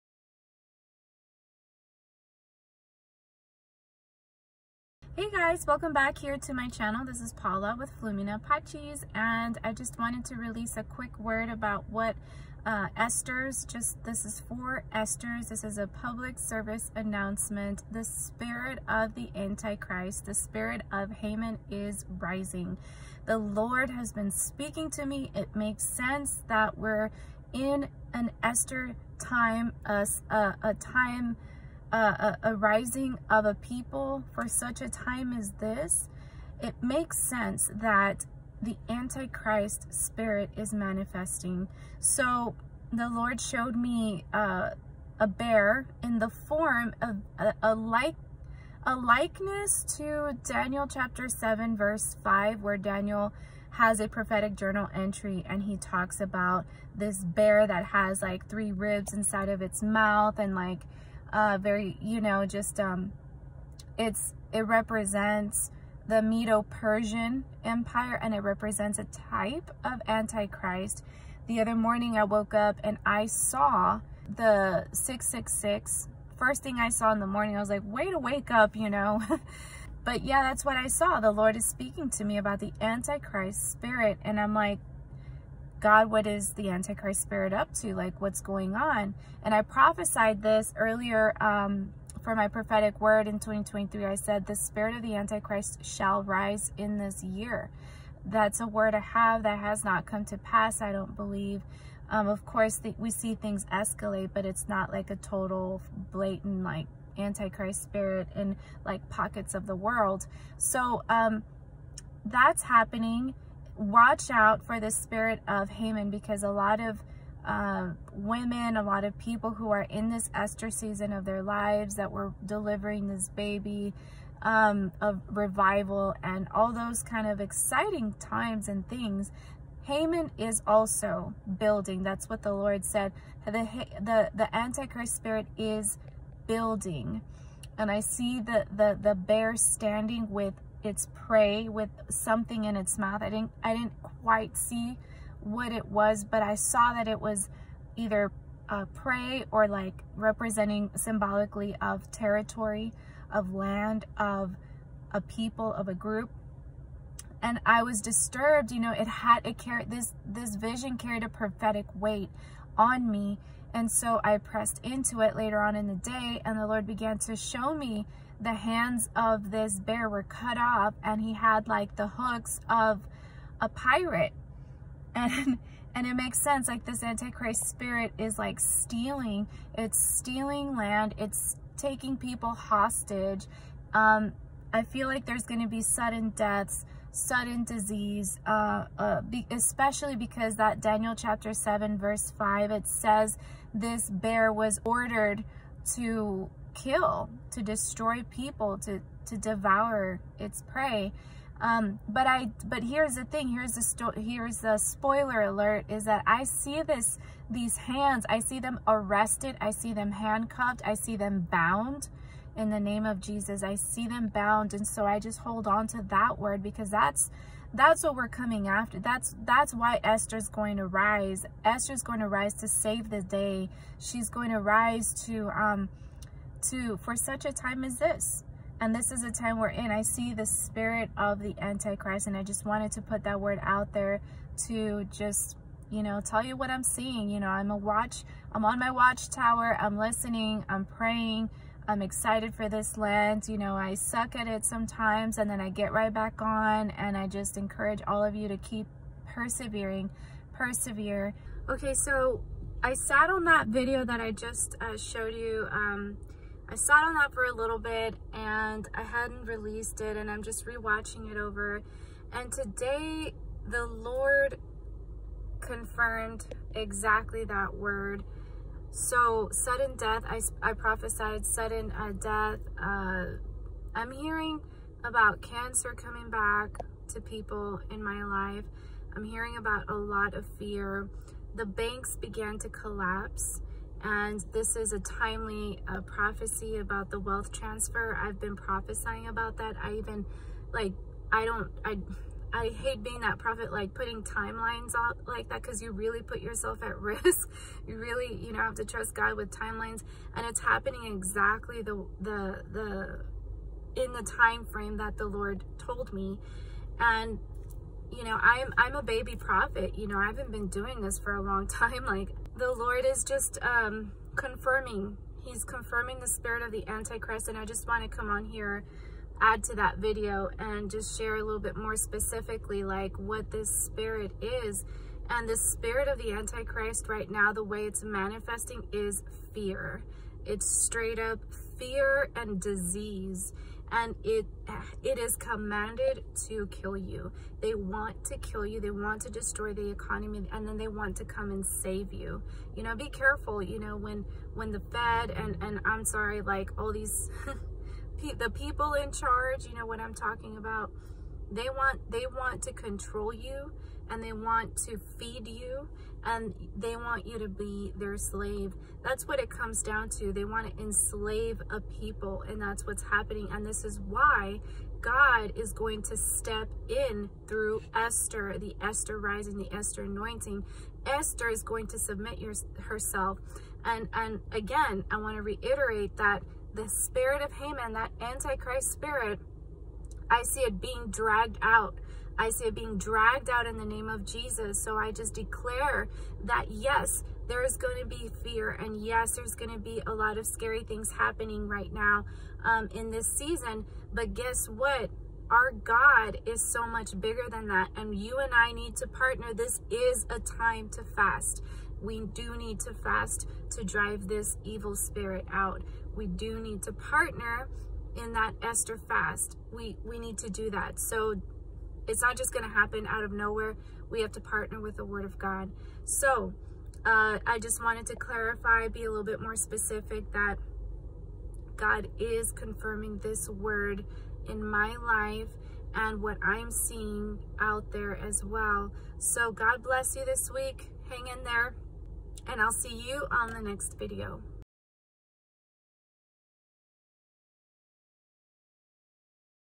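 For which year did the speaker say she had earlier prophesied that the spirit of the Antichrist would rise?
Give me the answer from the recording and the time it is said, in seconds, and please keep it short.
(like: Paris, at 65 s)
2023, at 93 s.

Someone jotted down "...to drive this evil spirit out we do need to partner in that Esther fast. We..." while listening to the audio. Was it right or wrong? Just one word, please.
right.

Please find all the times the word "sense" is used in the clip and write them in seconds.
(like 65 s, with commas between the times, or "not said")
25 s, 37 s, 176 s.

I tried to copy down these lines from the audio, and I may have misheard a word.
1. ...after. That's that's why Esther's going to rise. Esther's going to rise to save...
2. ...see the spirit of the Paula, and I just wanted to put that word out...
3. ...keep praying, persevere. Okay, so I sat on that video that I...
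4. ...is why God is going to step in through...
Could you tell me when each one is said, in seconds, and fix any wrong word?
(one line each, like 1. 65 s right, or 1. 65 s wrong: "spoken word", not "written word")
1. 218 s right
2. 230 s wrong: "Antichrist", not "Paula"
3. 248 s wrong: "persevering", not "praying"
4. 363 s right.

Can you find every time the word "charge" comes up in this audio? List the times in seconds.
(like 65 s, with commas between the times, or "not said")
349 s.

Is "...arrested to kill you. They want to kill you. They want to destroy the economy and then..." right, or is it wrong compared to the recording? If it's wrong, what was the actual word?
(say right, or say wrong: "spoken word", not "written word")
wrong: "commanded", not "arrested".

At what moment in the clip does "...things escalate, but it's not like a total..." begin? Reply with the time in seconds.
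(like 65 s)
103 s.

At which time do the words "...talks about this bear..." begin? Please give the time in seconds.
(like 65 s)
55 s.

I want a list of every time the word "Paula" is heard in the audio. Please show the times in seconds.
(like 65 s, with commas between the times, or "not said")
7 s.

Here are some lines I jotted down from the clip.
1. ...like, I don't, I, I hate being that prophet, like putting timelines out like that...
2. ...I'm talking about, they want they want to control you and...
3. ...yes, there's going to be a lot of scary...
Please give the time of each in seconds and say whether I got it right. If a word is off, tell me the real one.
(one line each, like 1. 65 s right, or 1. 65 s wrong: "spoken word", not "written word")
1. 290 s right
2. 349 s right
3. 389 s right.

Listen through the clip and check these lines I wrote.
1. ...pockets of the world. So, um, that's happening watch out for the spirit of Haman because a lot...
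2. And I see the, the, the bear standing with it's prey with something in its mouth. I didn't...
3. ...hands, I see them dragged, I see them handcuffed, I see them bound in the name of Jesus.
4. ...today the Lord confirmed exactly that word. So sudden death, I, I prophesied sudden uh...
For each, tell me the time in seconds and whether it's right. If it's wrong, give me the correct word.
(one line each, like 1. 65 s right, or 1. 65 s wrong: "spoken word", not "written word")
1. 109 s right
2. 137 s right
3. 207 s wrong: "arrested", not "dragged"
4. 262 s right.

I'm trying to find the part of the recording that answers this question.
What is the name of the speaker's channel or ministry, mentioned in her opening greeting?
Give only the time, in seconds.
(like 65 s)
8 s.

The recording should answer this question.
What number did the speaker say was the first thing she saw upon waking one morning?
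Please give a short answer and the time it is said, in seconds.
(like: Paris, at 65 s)
666, at 74 s.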